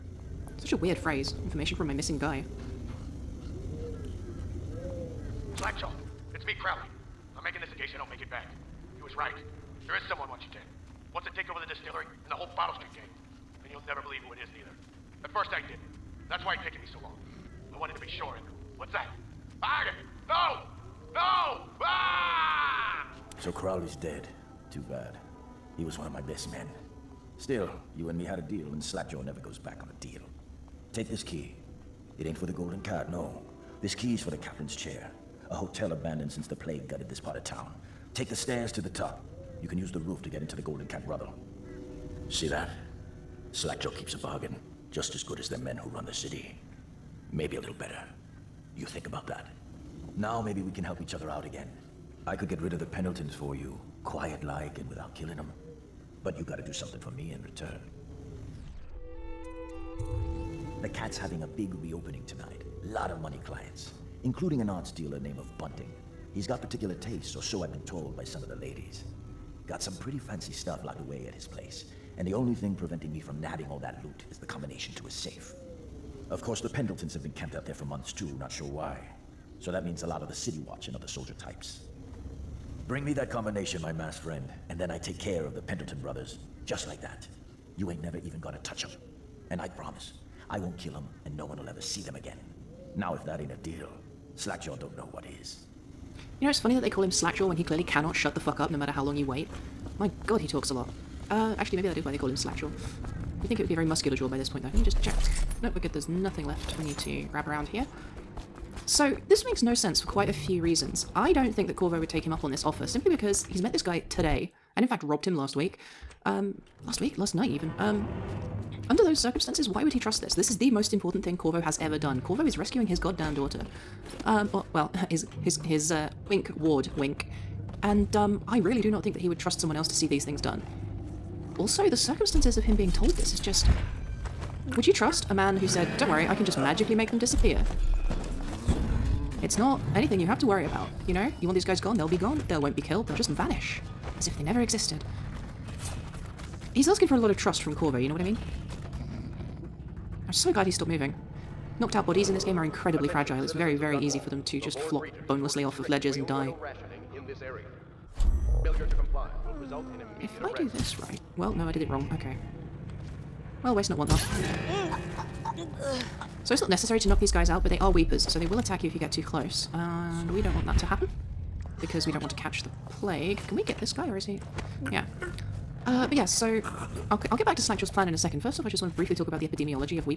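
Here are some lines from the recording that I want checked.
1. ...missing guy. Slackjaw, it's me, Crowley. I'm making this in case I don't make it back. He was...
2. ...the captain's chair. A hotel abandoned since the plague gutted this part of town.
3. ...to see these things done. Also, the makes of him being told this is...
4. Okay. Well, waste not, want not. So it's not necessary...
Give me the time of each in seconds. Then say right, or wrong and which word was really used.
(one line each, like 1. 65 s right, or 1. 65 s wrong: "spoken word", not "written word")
1. 1 s right
2. 34 s right
3. 129 s wrong: "circumstances", not "makes"
4. 162 s right.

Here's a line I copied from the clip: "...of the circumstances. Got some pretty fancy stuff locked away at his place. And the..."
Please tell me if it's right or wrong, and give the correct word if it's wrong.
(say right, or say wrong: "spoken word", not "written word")
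wrong: "ladies", not "circumstances".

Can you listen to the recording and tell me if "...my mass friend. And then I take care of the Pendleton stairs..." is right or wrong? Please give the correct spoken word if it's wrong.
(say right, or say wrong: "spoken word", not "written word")
wrong: "brothers", not "stairs".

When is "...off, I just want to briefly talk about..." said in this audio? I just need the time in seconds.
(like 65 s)
178 s.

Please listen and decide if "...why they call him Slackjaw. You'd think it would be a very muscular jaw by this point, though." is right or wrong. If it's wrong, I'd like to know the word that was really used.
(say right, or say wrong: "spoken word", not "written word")
right.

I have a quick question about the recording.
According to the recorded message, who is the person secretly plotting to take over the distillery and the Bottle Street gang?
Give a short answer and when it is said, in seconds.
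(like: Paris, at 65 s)
Arden, at 19 s.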